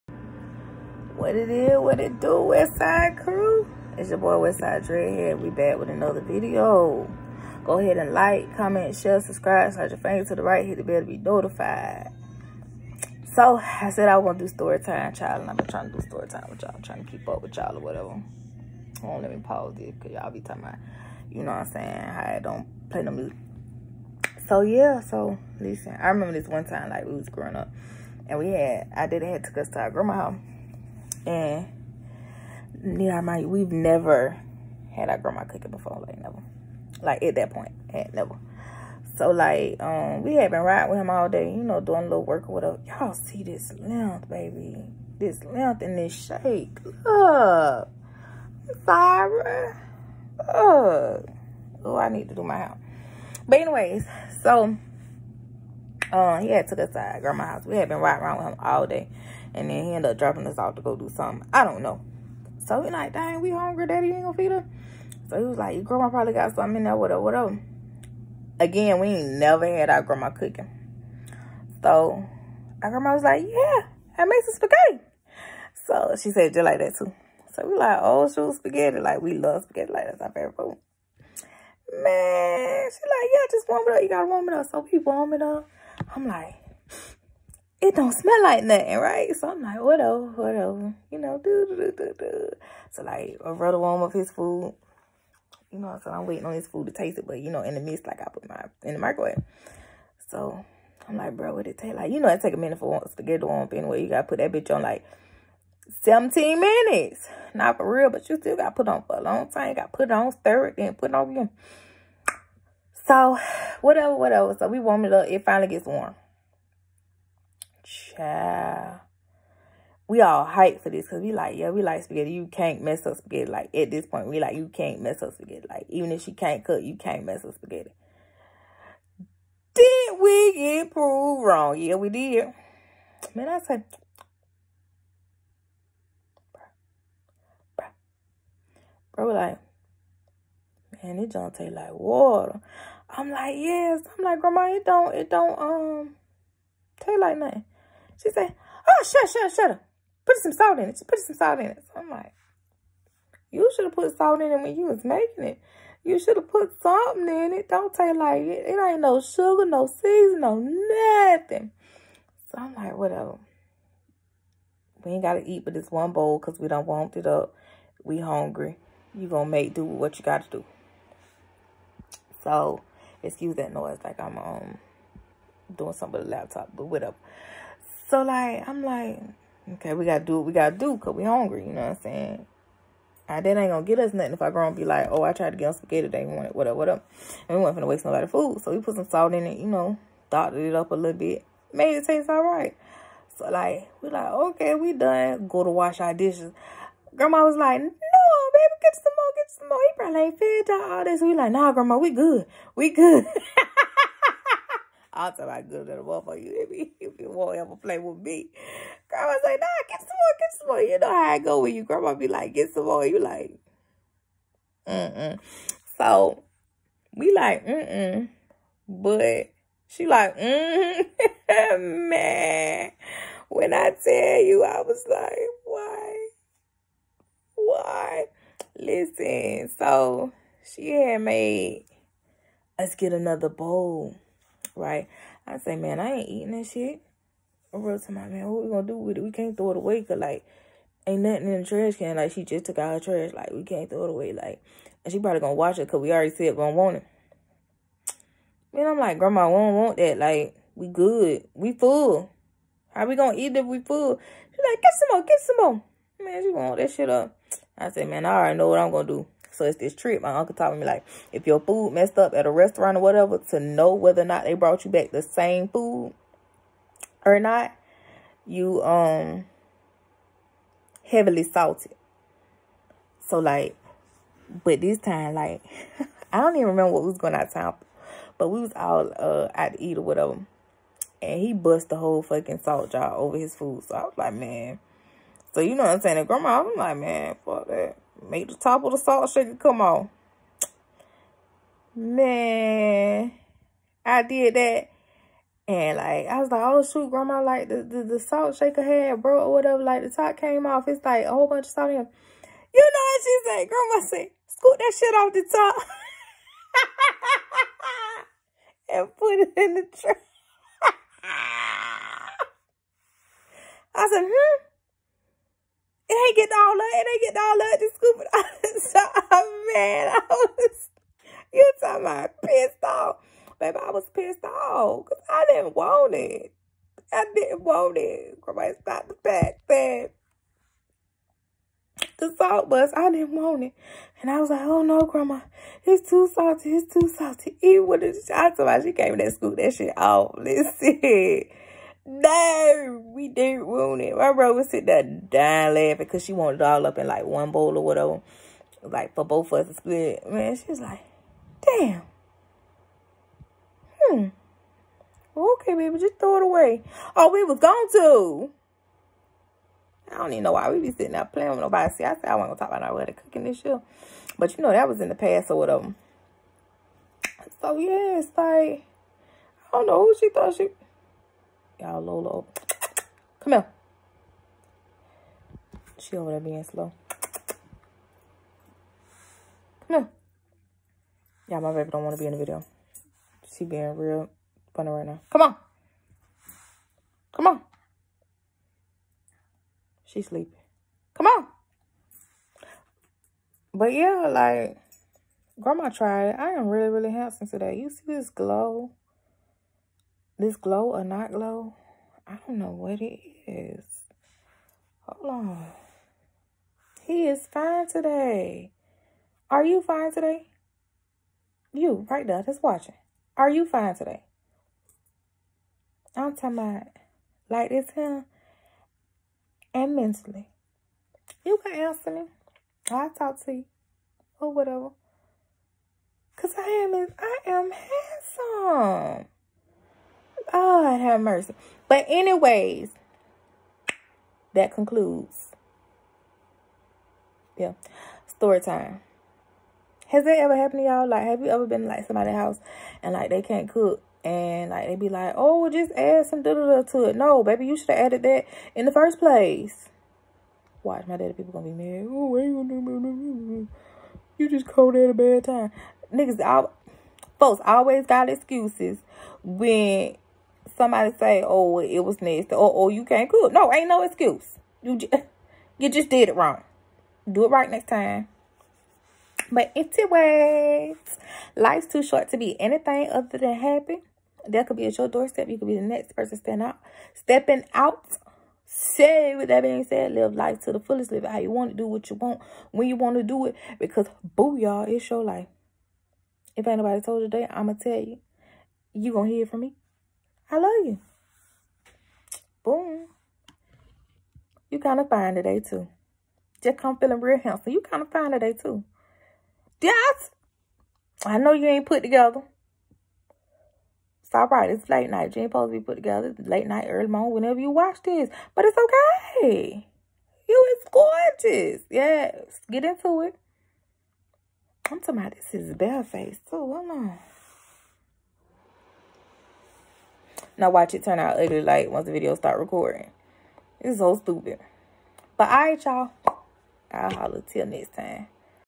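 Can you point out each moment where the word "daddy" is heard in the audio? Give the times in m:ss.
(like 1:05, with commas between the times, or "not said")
1:03, 7:31.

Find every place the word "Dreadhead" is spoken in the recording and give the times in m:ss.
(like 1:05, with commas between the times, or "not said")
0:04.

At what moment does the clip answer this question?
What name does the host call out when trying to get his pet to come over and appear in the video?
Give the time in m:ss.
6:11.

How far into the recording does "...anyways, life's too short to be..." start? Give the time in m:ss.
7:49.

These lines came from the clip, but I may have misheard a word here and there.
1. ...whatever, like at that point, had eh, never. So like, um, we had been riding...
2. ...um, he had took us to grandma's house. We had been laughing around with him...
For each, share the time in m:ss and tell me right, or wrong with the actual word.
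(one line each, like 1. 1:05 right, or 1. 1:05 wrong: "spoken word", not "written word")
1. 0:36 wrong: "never", not "whatever"
2. 0:56 wrong: "riding", not "laughing".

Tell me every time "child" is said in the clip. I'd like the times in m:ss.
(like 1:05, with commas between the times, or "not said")
0:15, 1:58.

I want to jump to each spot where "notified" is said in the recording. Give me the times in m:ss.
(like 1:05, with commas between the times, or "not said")
0:11.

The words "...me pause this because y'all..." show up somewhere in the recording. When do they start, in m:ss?
0:19.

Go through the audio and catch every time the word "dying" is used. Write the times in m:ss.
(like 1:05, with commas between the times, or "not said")
5:45.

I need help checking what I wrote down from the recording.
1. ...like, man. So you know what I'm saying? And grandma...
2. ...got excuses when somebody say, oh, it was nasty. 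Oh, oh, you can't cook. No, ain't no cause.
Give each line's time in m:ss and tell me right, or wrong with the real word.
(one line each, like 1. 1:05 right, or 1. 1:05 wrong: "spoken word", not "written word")
1. 4:44 right
2. 7:38 wrong: "excuse", not "cause".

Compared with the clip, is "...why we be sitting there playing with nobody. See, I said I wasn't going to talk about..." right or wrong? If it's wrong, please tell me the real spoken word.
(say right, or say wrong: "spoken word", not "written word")
right.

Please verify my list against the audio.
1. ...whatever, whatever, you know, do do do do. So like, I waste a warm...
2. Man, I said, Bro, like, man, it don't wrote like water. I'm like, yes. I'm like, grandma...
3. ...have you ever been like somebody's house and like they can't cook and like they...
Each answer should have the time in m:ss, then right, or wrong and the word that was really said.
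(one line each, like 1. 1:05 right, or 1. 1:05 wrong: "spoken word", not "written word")
1. 1:29 wrong: "wrote", not "waste"
2. 2:13 wrong: "taste", not "wrote"
3. 7:21 right.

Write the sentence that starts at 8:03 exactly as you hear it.
Because, boo, y'all, it's your life.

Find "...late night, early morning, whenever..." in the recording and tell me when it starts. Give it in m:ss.
8:26.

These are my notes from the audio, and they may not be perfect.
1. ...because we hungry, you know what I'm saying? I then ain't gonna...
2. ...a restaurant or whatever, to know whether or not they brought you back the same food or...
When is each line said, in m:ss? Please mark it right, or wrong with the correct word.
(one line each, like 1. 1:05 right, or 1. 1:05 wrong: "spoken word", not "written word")
1. 3:00 right
2. 4:22 right.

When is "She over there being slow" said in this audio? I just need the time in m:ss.
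6:15.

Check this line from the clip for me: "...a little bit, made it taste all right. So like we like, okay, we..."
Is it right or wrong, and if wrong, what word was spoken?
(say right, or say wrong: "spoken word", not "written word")
right.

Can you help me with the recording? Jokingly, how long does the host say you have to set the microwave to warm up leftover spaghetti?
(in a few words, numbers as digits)
17 minutes.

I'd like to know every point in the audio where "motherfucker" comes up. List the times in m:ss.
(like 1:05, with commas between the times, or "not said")
3:26.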